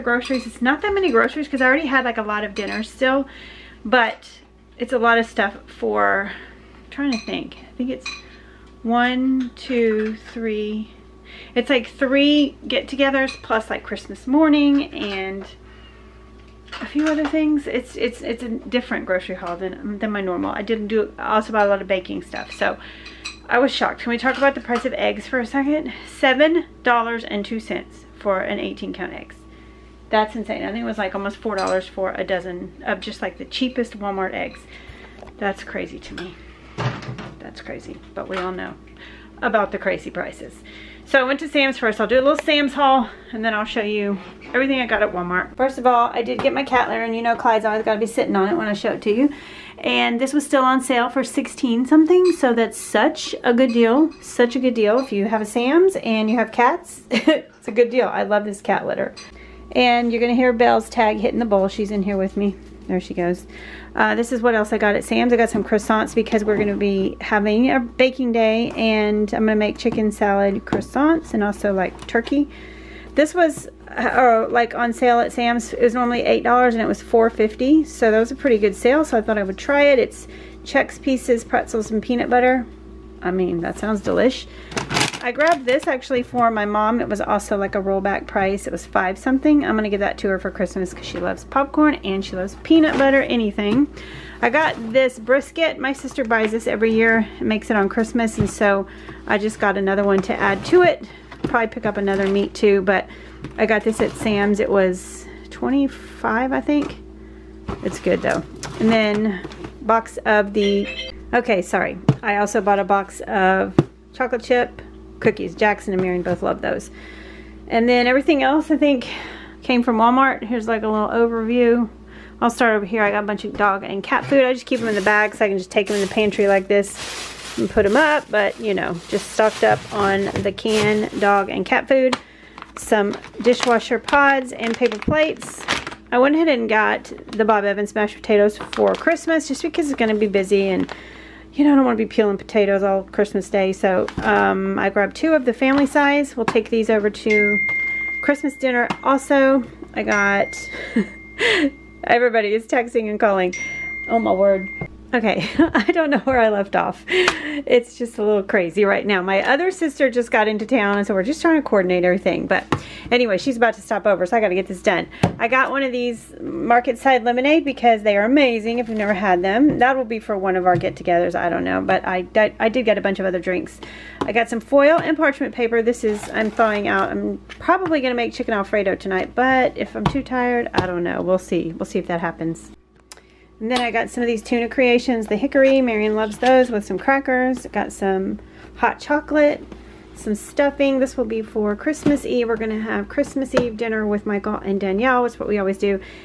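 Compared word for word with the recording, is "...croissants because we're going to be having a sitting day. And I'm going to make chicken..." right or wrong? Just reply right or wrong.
wrong.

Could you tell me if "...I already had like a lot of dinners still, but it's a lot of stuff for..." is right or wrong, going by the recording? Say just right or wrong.
right.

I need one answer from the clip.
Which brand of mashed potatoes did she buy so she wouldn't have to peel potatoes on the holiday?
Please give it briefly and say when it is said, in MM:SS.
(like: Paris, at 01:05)
Bob Evans, at 02:17.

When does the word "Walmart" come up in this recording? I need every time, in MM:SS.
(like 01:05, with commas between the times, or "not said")
00:33, 00:45, 01:59.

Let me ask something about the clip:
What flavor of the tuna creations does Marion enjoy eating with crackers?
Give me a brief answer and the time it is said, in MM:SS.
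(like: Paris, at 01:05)
Hickory, at 03:05.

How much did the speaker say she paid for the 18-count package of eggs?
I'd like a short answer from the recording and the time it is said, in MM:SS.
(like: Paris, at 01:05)
$7.02, at 00:26.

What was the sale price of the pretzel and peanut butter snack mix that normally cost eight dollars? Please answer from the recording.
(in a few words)
$4.50.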